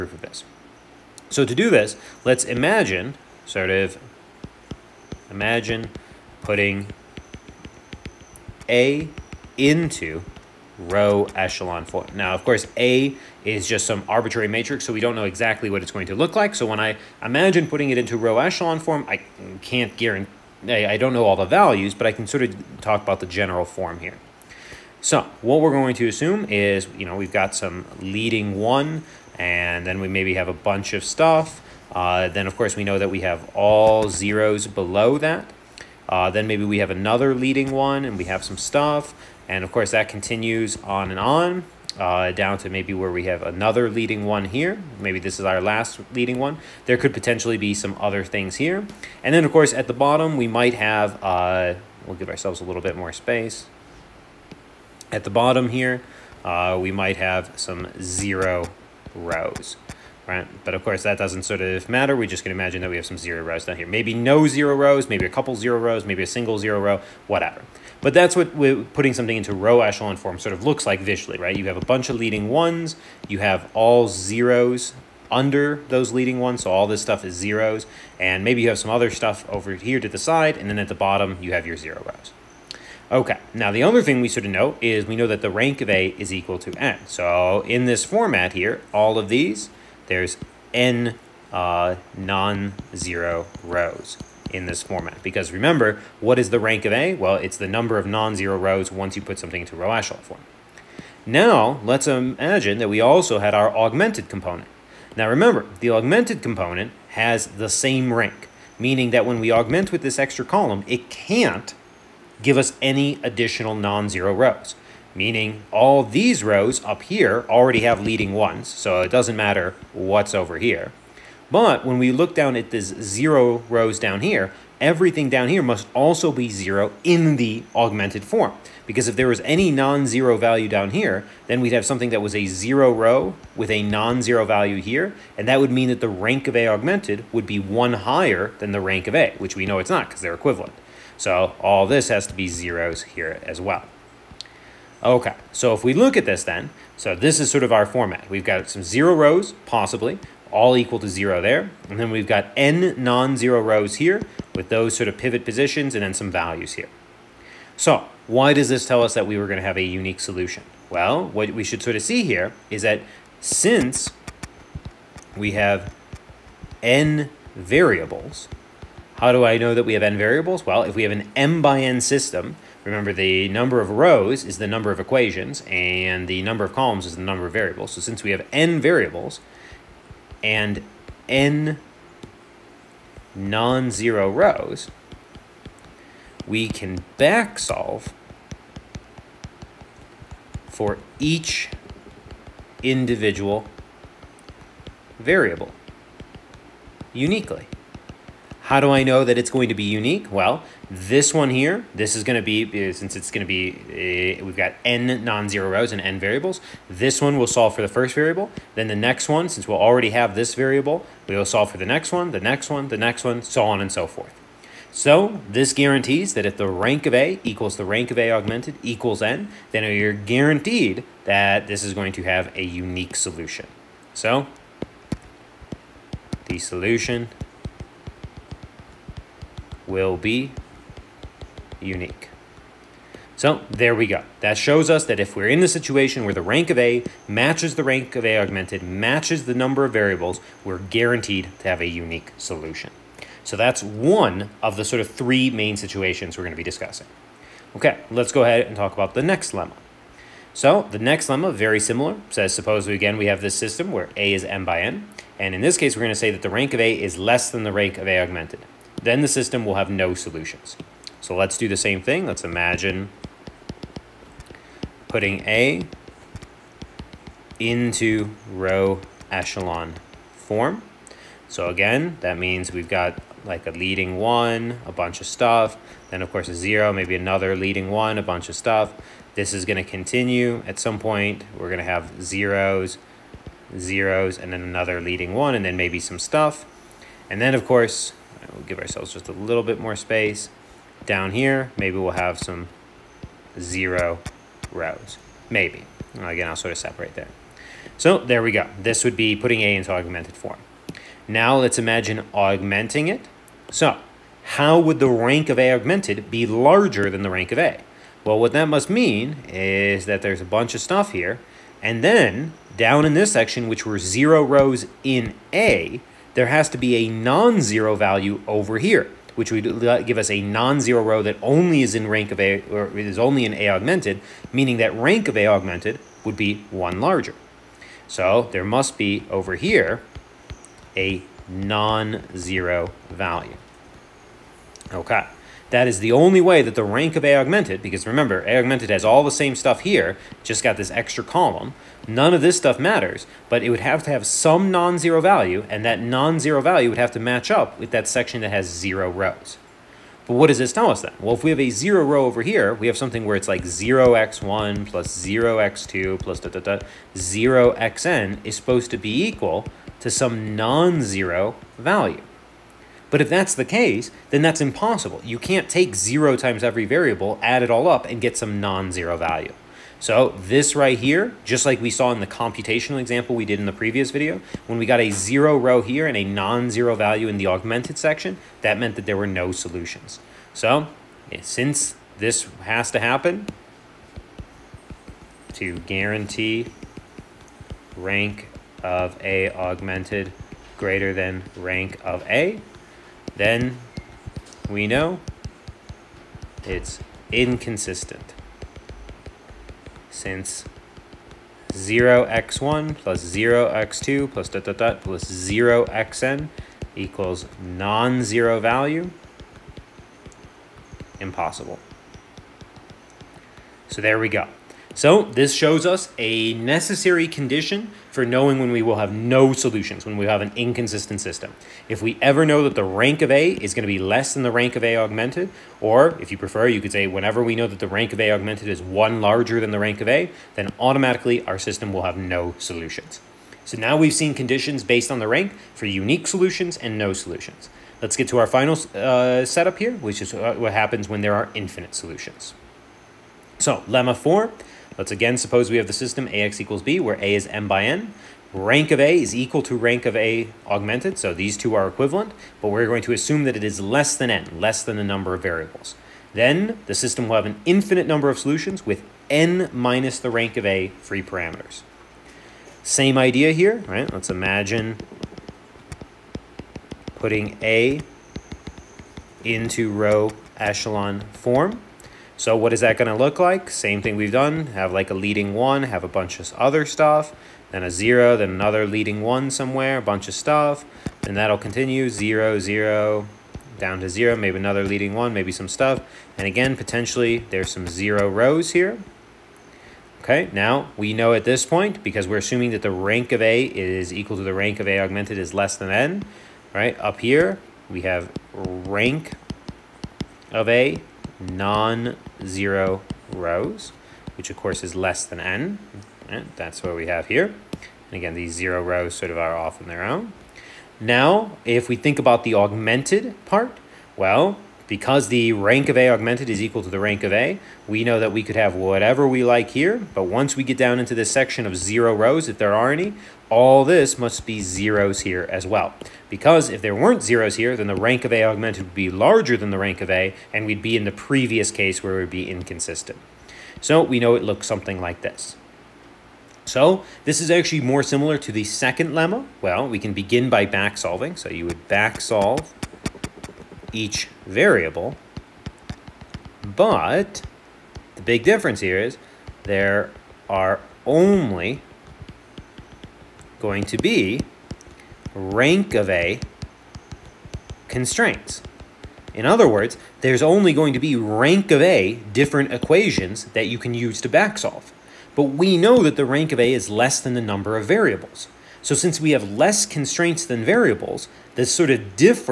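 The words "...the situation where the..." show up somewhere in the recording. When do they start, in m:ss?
3:55.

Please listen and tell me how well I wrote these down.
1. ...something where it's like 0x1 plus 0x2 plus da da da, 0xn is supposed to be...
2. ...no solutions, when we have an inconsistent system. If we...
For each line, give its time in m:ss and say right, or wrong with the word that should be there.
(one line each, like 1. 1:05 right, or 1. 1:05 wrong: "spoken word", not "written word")
1. 5:52 right
2. 6:59 right.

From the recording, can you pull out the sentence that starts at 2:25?
Okay, so if we look at this then, so this is sort of our format.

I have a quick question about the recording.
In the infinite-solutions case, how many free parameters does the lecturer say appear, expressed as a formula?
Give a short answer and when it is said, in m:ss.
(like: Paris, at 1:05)
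n minus the rank of A, at 7:39.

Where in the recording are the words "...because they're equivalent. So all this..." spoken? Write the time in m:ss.
2:20.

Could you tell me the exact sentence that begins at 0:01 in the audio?
So to do this, let's imagine, sort of, imagine putting A into row echelon form.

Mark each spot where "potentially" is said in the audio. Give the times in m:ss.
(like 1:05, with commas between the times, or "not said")
0:47, 8:06.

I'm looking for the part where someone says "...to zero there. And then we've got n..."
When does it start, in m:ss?
2:31.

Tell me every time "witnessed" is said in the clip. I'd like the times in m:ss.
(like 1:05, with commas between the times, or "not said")
not said.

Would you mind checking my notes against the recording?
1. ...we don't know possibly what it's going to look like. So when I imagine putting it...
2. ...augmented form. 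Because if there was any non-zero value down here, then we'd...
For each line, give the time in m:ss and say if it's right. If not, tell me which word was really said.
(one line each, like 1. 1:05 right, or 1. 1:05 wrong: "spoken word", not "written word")
1. 0:14 wrong: "exactly", not "possibly"
2. 2:07 right.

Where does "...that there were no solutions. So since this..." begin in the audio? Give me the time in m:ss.
6:18.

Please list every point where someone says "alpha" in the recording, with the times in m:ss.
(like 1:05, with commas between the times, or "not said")
not said.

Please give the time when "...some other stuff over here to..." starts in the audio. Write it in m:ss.
1:18.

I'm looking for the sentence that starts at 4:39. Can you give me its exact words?
This is gonna continue at some point.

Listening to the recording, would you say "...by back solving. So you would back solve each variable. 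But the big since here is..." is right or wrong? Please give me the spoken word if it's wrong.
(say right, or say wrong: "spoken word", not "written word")
wrong: "difference", not "since".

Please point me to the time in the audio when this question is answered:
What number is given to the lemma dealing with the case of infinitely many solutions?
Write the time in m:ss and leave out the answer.
7:23.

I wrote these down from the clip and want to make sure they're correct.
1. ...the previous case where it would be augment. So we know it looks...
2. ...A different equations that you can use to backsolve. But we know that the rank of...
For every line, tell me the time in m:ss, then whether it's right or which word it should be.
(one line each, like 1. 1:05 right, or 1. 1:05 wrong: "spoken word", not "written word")
1. 8:51 wrong: "inconsistent", not "augment"
2. 9:21 right.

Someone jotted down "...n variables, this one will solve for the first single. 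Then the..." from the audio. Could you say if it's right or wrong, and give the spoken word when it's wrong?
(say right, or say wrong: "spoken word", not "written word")
wrong: "variable", not "single".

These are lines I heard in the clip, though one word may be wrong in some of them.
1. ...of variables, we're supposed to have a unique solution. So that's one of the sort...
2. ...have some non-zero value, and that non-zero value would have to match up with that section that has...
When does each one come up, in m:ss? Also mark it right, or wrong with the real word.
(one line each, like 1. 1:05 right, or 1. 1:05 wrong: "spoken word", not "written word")
1. 3:59 wrong: "guaranteed", not "supposed"
2. 5:44 right.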